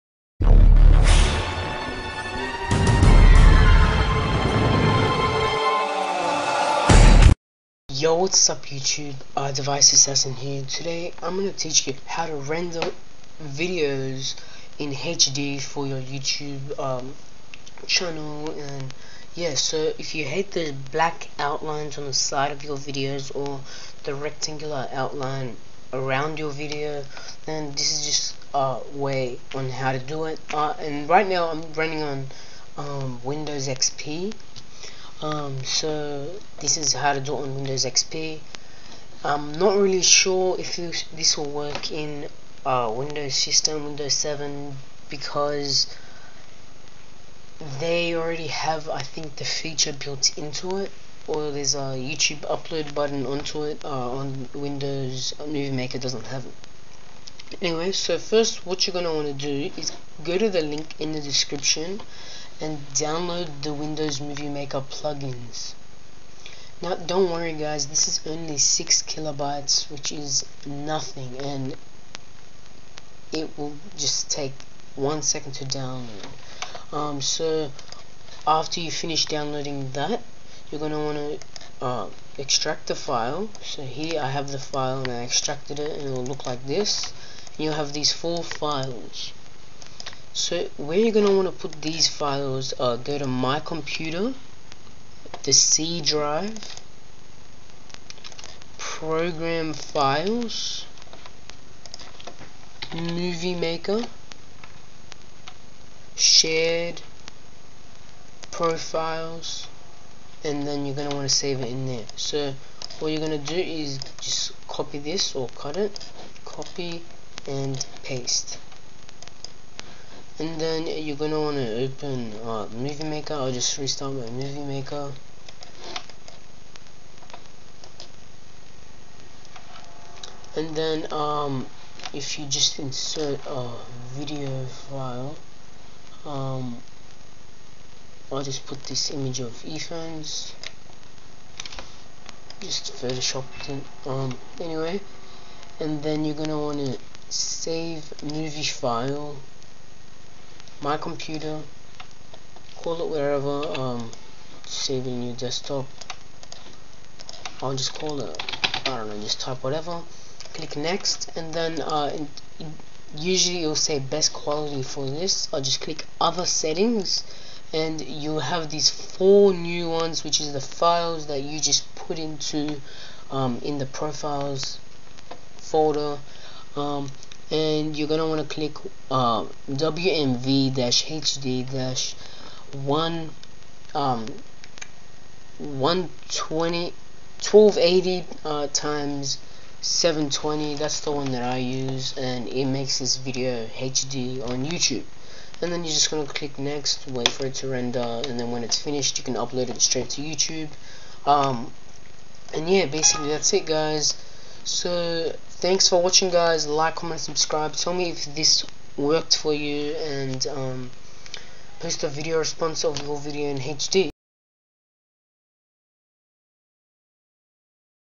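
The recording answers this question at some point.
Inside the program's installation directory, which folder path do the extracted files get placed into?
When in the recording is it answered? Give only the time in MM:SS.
01:46.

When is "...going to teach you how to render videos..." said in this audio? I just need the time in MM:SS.
00:11.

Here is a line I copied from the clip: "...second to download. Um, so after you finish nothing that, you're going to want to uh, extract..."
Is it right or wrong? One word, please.
wrong.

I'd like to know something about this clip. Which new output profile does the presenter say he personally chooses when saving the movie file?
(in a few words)
WMV-HD 1280x720.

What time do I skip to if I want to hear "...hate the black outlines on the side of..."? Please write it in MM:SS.
00:20.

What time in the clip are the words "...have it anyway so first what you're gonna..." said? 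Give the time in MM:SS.
00:56.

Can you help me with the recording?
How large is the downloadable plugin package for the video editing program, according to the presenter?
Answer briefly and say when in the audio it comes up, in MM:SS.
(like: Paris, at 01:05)
6 kilobytes, at 01:08.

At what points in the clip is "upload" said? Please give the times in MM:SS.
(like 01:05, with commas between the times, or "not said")
00:52, 03:19.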